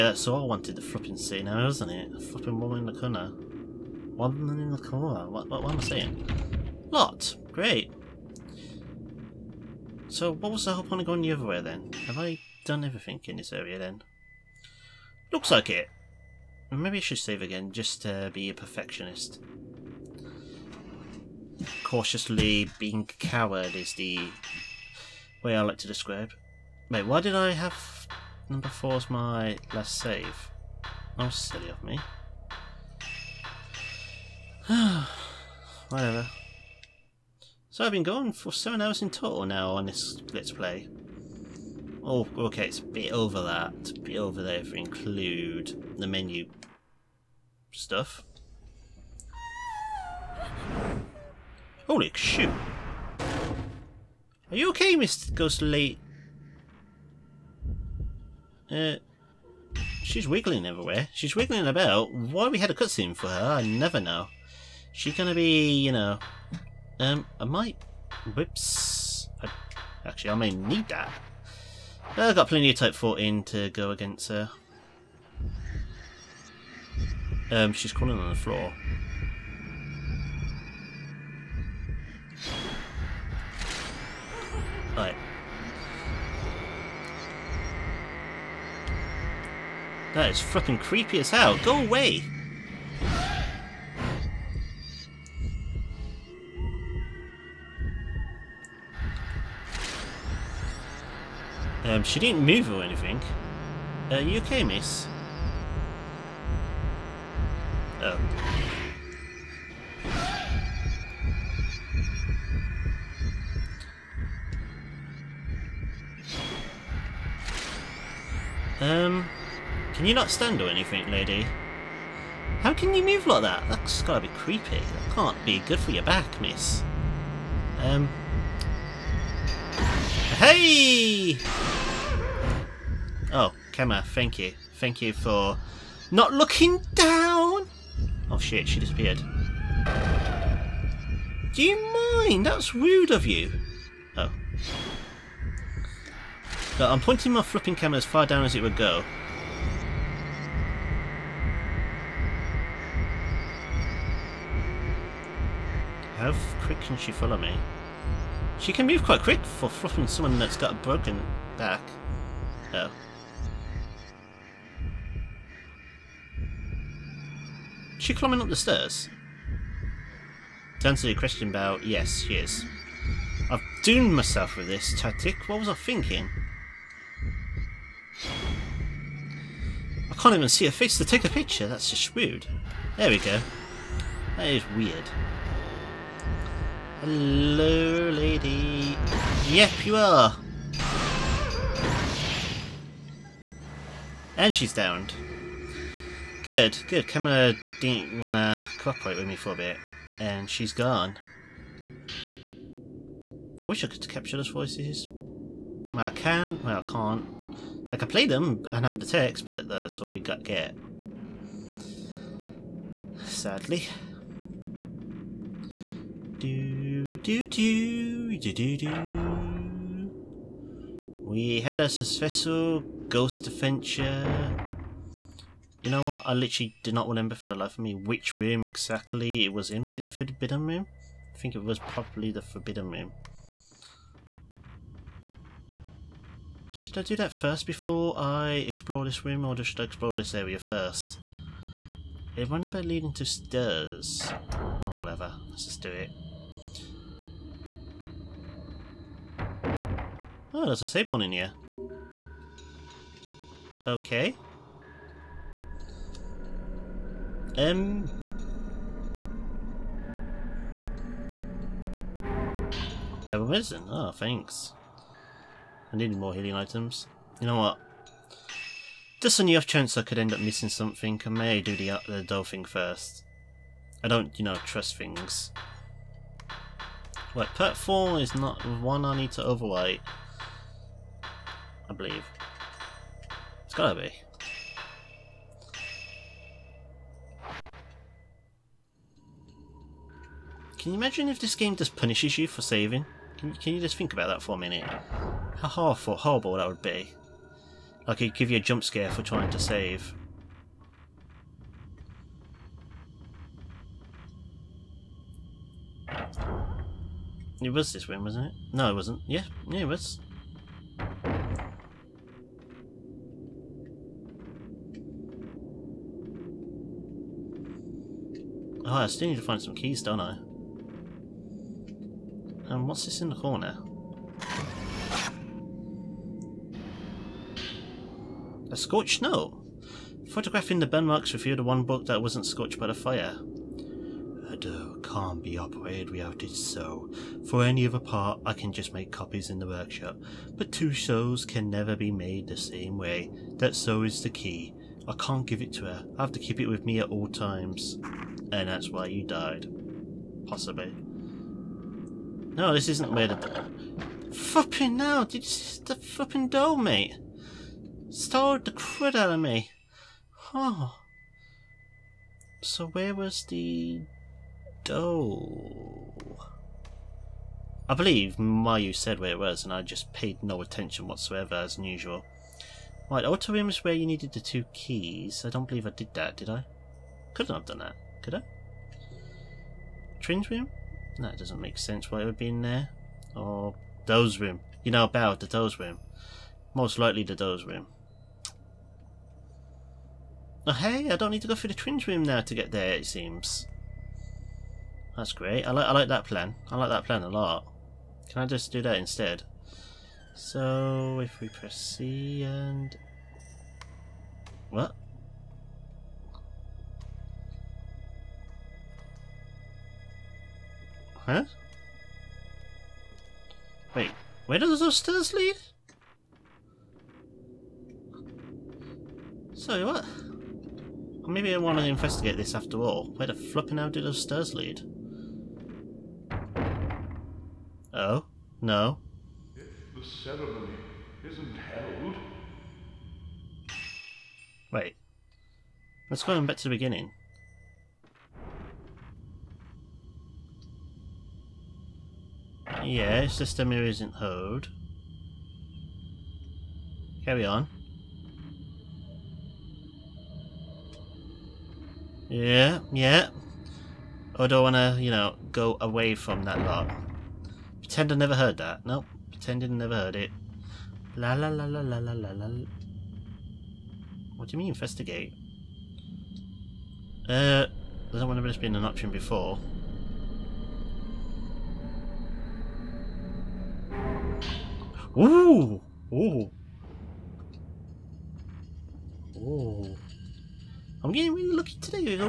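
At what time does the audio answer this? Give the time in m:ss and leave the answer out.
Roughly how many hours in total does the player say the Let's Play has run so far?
0:38.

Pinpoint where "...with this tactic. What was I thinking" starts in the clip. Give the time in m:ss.
2:54.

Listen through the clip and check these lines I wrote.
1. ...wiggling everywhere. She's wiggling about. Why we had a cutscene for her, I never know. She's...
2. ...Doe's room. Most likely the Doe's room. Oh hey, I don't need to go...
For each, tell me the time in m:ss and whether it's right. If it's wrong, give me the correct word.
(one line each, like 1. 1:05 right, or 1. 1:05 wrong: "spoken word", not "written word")
1. 1:00 right
2. 6:25 right.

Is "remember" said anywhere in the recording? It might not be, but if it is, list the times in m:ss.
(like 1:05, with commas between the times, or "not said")
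3:47, 7:48.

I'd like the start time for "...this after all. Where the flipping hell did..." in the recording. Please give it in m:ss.
7:02.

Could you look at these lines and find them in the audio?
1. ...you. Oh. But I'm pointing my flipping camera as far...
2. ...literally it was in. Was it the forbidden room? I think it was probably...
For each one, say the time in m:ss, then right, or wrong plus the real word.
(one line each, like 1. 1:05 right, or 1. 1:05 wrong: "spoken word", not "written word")
1. 2:23 right
2. 3:48 wrong: "exactly", not "literally".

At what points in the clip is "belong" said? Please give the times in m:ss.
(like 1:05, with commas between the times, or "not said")
not said.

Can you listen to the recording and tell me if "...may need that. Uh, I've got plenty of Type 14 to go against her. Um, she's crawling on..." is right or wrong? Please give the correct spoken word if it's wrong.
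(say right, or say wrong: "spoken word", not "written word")
right.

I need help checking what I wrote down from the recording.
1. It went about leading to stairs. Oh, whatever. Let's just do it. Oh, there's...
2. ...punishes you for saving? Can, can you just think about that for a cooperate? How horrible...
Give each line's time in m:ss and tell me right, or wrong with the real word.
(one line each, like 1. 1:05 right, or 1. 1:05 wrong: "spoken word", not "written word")
1. 4:02 right
2. 4:51 wrong: "minute", not "cooperate".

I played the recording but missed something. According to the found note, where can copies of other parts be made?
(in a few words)
The workshop.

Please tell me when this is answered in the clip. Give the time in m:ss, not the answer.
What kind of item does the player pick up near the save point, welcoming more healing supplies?
4:23.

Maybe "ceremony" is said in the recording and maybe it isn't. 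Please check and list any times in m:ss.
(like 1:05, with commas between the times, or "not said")
7:10.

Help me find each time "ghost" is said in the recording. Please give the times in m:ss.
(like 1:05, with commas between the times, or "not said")
0:55, 3:43.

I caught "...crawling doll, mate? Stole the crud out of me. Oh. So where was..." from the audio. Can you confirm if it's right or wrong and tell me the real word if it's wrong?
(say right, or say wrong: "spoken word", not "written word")
wrong: "flipping", not "crawling".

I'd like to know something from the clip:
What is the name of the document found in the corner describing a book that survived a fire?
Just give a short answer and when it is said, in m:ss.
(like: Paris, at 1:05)
A scorched note, at 5:28.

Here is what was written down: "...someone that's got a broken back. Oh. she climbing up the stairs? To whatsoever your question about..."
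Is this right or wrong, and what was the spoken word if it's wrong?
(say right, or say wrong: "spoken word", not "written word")
wrong: "answer", not "whatsoever".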